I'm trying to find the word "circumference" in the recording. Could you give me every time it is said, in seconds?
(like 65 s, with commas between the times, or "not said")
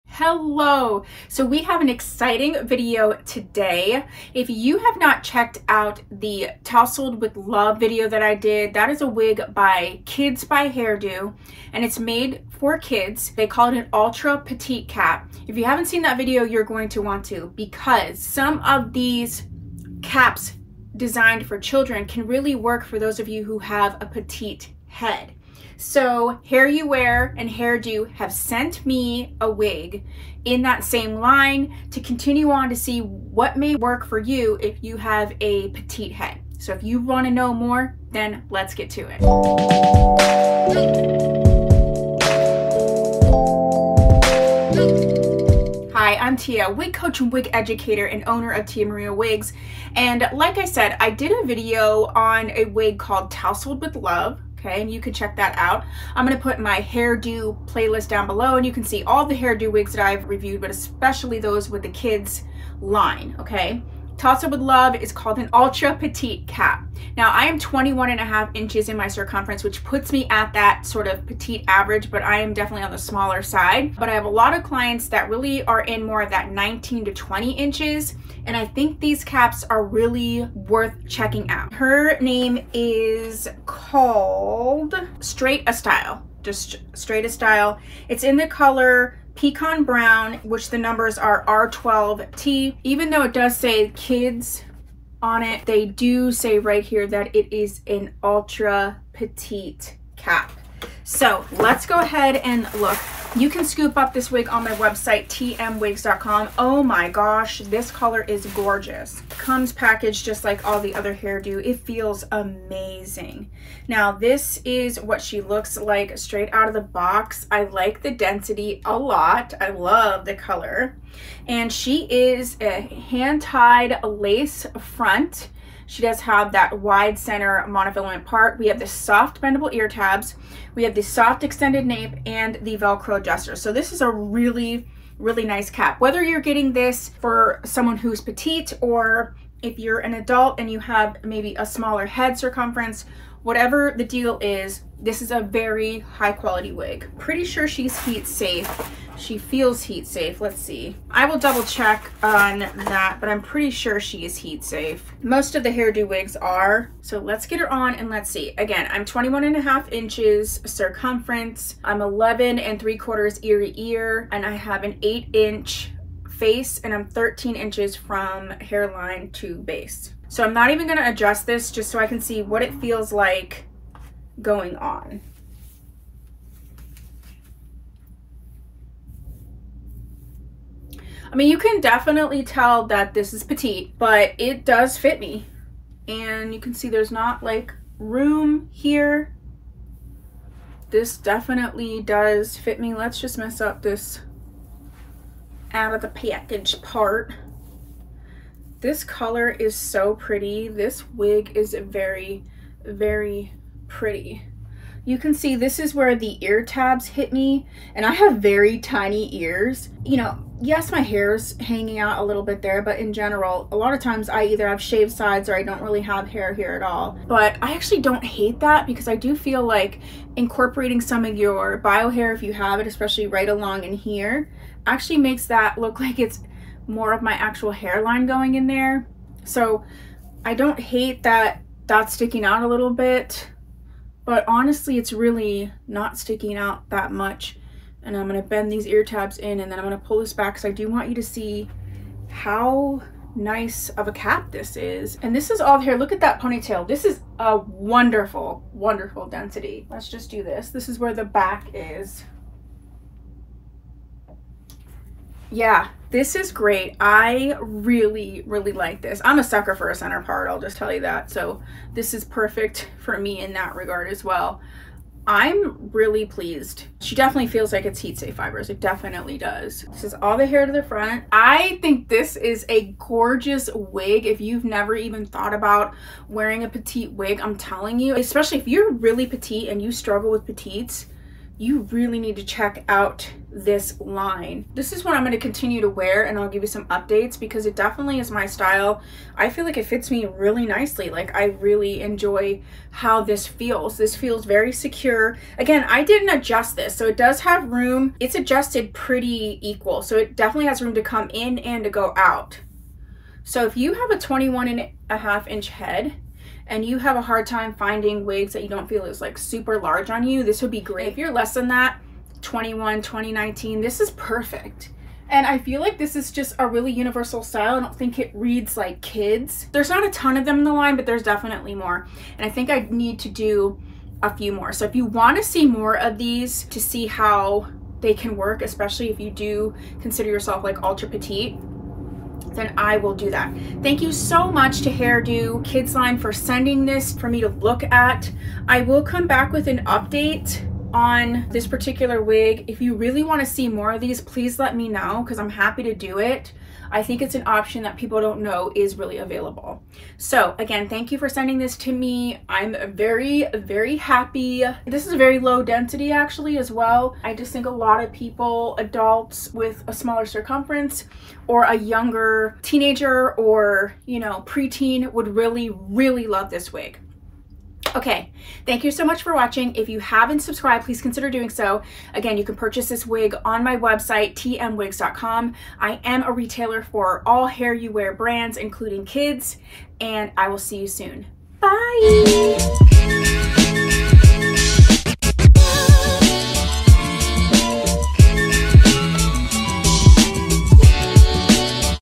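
69 s, 142 s, 160 s, 360 s.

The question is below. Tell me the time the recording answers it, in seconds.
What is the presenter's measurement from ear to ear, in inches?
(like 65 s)
162 s.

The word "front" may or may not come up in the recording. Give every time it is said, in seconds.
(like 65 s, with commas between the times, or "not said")
124 s, 270 s.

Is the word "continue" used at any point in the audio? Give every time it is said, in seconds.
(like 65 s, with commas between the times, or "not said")
32 s, 285 s.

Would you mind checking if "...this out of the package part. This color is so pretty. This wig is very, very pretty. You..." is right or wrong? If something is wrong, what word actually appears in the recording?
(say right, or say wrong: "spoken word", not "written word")
right.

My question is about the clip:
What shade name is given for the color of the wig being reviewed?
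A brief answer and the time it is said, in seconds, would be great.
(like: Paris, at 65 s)
pecan brown, at 89 s.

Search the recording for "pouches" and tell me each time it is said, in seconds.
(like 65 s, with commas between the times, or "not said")
not said.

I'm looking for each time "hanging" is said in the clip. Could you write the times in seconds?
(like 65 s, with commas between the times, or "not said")
211 s.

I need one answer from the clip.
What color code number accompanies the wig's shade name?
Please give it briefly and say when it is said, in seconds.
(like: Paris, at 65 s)
R12T, at 91 s.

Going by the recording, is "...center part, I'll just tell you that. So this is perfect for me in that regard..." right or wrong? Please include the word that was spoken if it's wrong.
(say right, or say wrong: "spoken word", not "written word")
right.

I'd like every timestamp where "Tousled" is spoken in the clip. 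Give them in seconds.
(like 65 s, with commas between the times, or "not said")
6 s, 53 s, 64 s.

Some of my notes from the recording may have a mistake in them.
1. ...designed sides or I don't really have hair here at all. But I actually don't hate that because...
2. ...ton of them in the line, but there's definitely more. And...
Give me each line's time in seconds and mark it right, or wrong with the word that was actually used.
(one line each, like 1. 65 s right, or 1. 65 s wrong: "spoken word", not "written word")
1. 214 s wrong: "shaved", not "designed"
2. 320 s right.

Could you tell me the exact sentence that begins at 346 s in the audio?
I think it's an option that people don't know is really available.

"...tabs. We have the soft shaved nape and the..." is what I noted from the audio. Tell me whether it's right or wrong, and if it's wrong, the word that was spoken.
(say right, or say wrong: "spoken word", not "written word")
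wrong: "extended", not "shaved".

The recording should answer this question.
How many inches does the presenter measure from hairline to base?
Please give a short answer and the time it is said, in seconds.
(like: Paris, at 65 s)
13 inches, at 167 s.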